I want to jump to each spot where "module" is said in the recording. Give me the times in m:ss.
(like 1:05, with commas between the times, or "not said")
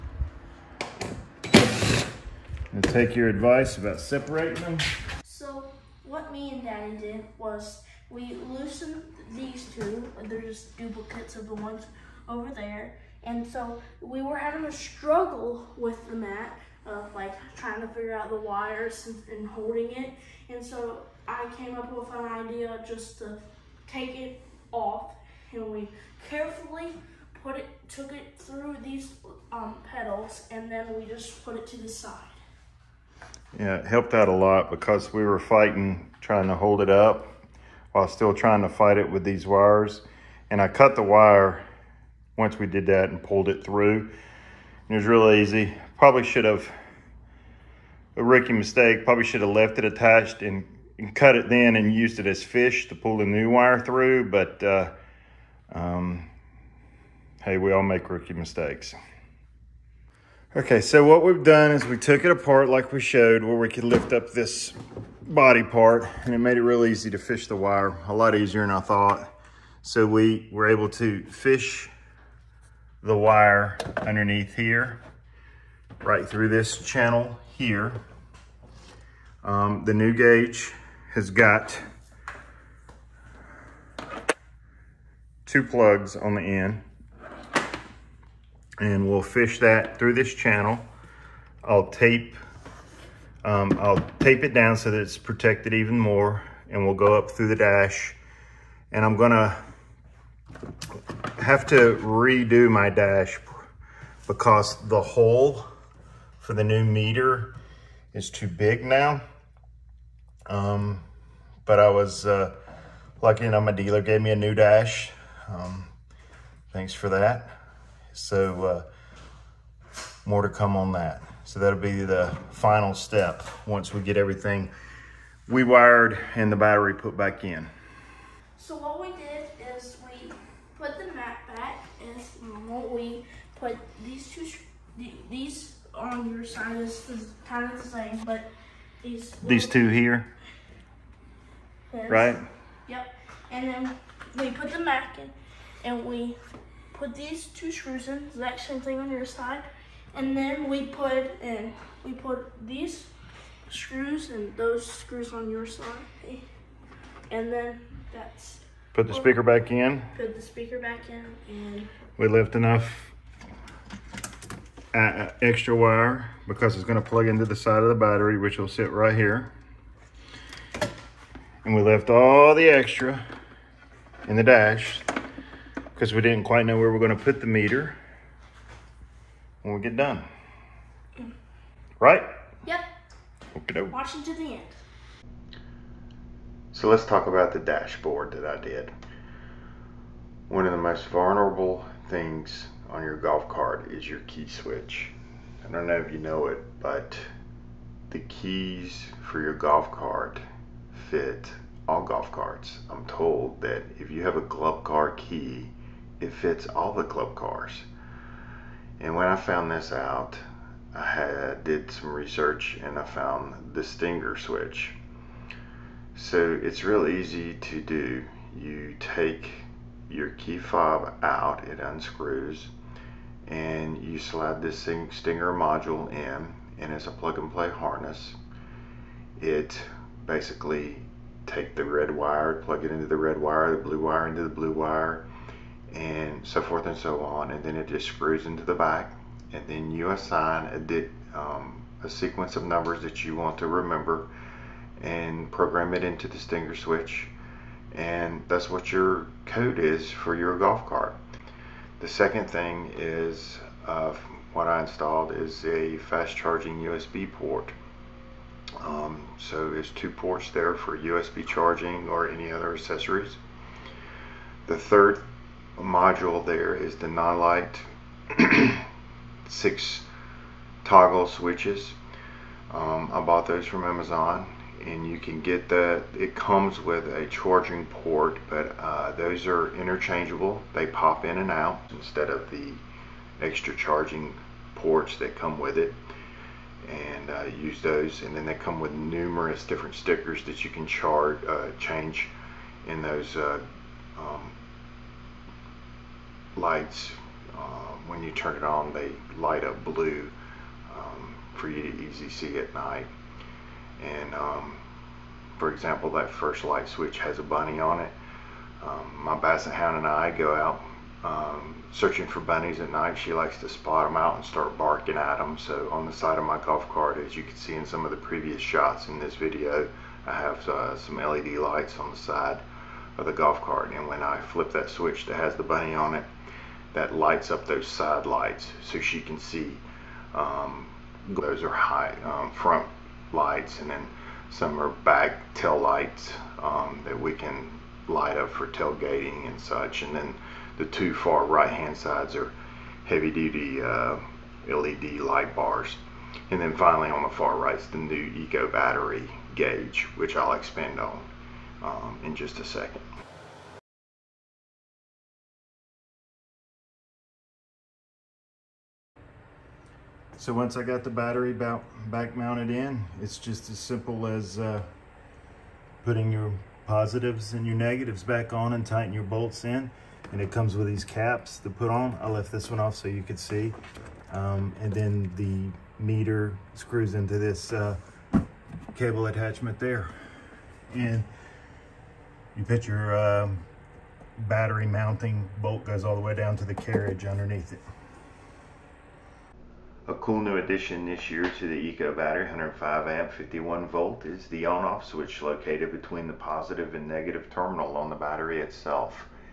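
3:45, 4:25.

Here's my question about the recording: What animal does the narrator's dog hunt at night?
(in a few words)
bunnies.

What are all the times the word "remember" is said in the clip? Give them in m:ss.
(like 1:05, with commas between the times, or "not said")
4:03.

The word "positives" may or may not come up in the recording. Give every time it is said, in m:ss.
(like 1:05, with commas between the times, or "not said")
6:06, 6:36.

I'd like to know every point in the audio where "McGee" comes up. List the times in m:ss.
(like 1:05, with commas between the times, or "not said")
not said.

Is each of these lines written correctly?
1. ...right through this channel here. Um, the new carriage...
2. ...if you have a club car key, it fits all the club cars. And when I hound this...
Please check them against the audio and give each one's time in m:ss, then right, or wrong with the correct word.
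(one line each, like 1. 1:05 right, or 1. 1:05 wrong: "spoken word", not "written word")
1. 1:16 wrong: "gauge", not "carriage"
2. 3:23 wrong: "found", not "hound".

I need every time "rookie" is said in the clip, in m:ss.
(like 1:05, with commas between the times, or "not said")
0:48, 0:58.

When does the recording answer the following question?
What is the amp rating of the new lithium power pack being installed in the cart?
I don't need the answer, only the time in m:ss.
6:32.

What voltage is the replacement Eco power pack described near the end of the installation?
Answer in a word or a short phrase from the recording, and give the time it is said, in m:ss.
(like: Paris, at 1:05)
51 volt, at 6:33.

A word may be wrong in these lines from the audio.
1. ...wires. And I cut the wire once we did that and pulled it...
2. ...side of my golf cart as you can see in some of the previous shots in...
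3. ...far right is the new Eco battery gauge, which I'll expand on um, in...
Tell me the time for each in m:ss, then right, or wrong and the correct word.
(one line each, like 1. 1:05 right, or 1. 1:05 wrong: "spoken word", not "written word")
1. 0:39 right
2. 5:16 right
3. 5:47 right.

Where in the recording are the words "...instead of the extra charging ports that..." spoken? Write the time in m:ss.
4:41.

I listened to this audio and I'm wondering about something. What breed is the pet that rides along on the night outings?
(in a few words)
basset hound.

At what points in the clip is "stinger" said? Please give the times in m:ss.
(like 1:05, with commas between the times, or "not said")
3:33, 3:45, 4:06.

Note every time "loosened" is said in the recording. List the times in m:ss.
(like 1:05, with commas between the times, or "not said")
0:08.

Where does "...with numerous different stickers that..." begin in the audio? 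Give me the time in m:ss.
4:48.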